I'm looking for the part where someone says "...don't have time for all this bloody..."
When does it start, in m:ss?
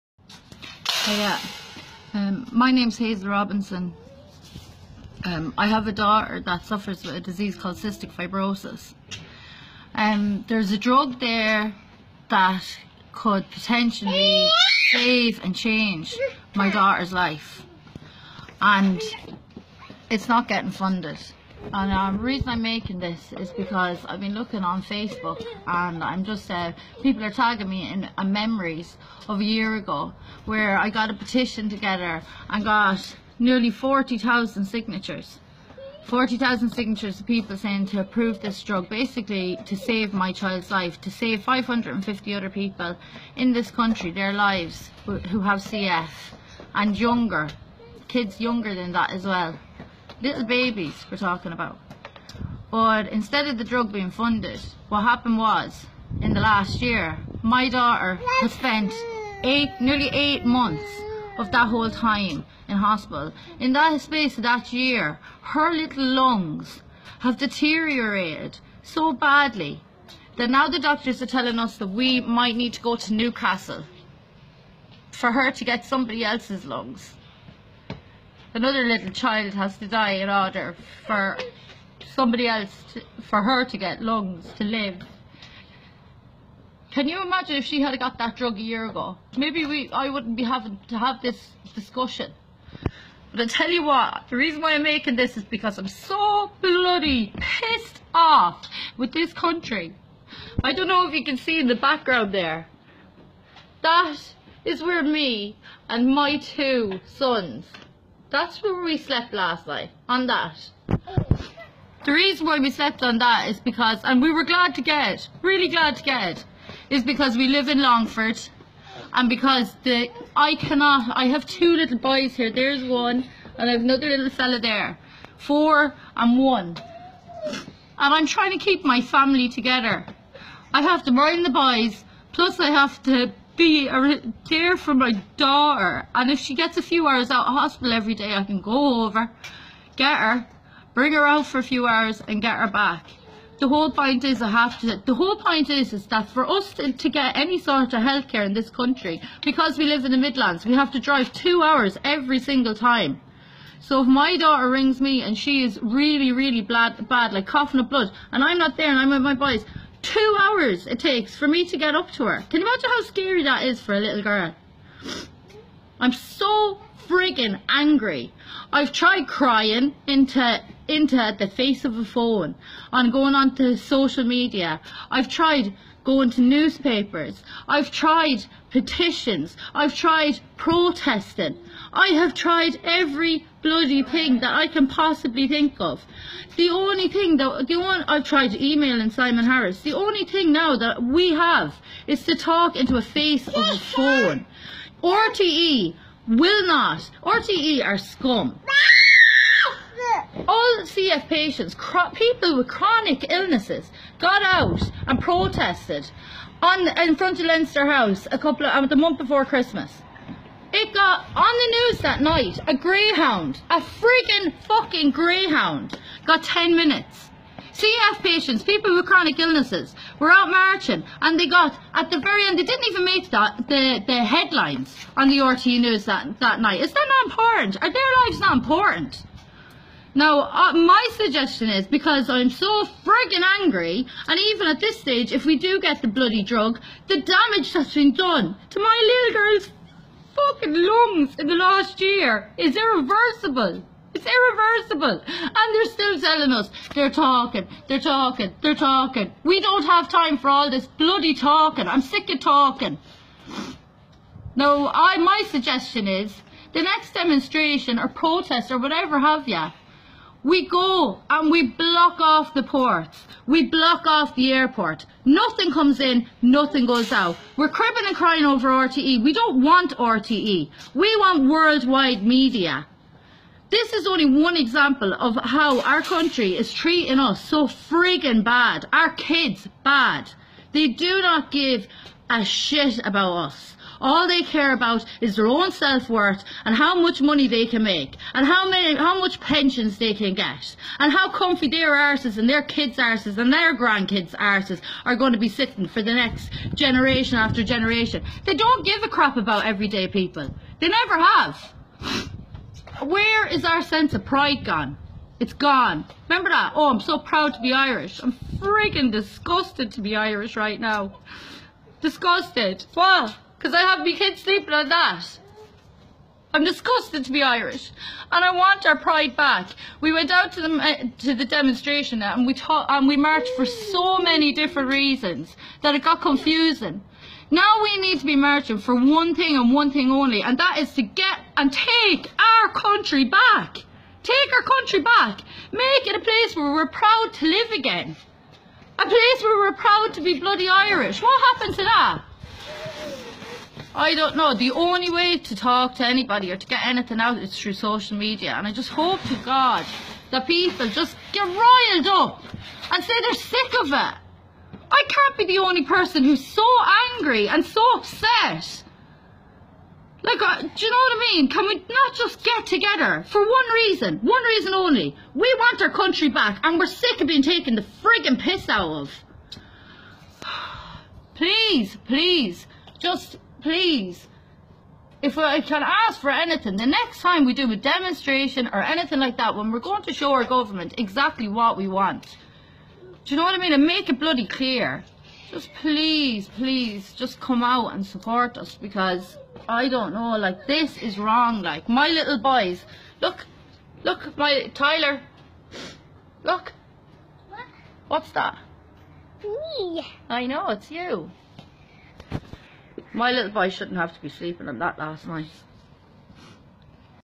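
4:09.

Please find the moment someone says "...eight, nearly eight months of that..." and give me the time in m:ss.
0:59.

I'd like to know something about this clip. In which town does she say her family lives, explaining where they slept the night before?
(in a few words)
Longford.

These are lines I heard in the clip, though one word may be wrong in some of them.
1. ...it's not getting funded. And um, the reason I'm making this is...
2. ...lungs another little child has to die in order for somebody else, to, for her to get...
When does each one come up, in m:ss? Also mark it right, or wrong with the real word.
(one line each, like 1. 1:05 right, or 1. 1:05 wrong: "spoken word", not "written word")
1. 0:20 right
2. 1:16 right.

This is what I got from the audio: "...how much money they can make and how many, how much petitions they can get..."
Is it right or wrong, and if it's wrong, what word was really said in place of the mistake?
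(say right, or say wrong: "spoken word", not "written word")
wrong: "pensions", not "petitions".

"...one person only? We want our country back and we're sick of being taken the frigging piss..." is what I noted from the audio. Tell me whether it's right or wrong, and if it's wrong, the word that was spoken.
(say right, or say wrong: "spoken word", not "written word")
wrong: "reason", not "person".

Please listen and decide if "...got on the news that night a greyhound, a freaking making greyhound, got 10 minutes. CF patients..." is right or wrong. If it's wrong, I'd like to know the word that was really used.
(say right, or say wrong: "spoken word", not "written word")
wrong: "fucking", not "making".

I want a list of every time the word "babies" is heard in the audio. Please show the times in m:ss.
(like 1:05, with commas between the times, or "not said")
0:50.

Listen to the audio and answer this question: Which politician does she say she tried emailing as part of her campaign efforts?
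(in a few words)
Simon Harris.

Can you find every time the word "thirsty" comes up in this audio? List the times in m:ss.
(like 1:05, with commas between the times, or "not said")
not said.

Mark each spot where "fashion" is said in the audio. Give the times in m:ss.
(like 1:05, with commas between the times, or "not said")
not said.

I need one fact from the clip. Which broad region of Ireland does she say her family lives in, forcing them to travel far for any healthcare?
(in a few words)
The Midlands.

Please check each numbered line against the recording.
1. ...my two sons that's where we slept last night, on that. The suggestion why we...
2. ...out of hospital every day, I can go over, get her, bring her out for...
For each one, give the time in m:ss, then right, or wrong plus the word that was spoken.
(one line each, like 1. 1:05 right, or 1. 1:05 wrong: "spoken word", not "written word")
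1. 1:46 wrong: "reason", not "suggestion"
2. 2:17 right.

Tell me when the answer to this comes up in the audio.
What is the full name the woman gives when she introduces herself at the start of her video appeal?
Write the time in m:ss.
0:02.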